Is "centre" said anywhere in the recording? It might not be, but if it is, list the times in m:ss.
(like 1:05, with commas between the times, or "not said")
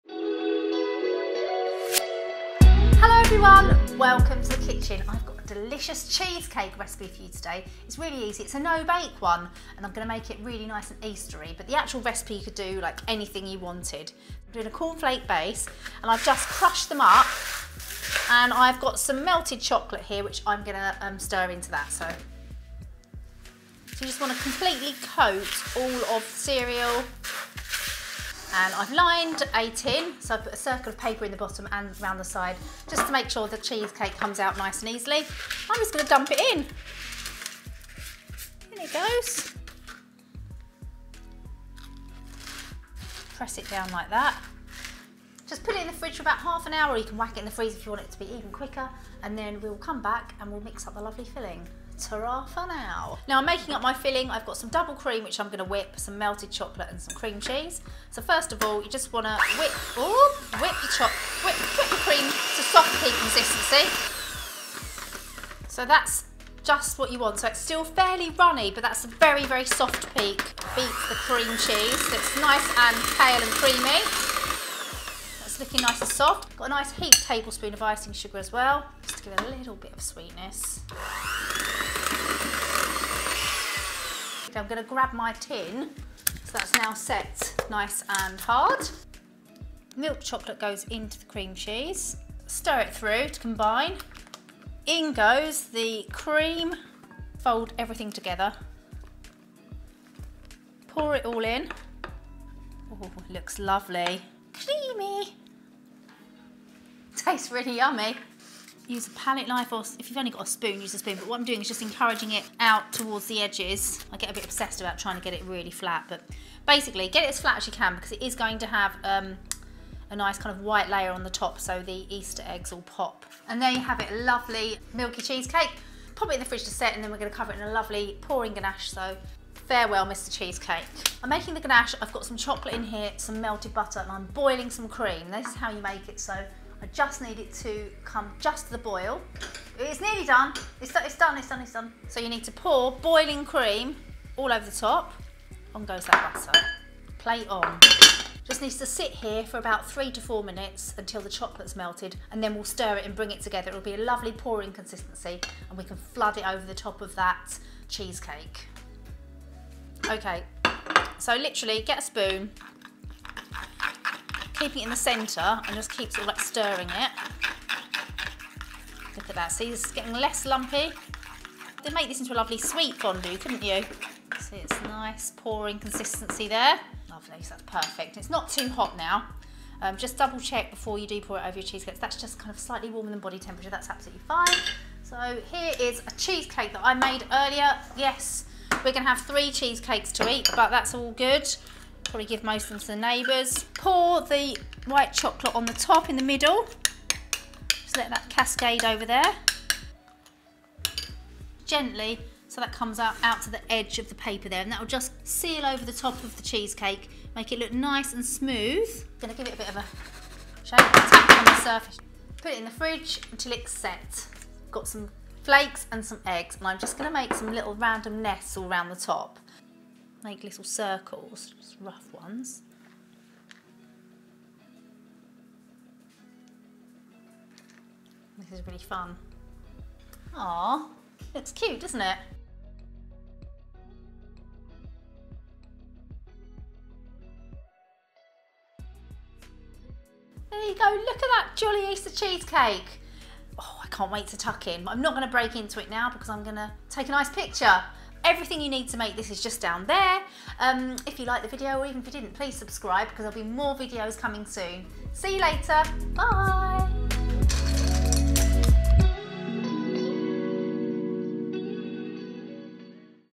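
2:44.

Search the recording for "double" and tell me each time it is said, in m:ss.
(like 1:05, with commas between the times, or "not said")
0:54, 3:00.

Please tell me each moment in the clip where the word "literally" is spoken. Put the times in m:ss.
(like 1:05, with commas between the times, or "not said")
2:41.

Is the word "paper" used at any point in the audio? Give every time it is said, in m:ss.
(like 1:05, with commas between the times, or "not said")
0:30, 3:24.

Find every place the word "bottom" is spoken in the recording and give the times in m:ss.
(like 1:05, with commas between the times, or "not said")
0:31.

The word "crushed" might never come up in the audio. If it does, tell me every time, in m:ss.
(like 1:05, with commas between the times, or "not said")
0:16.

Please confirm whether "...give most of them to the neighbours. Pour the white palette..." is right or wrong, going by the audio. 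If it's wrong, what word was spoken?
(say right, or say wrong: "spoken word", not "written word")
wrong: "chocolate", not "palette".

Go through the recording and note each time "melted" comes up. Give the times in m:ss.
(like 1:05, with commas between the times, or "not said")
0:19, 0:56, 2:13, 2:31.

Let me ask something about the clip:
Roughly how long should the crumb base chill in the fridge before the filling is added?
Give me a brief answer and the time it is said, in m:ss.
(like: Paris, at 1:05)
Half an hour, at 0:46.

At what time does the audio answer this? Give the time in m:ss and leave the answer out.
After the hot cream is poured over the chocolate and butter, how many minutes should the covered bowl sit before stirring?
2:29.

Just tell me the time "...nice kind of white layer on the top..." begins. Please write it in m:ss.
2:00.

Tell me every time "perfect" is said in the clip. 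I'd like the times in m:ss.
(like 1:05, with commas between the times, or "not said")
2:57.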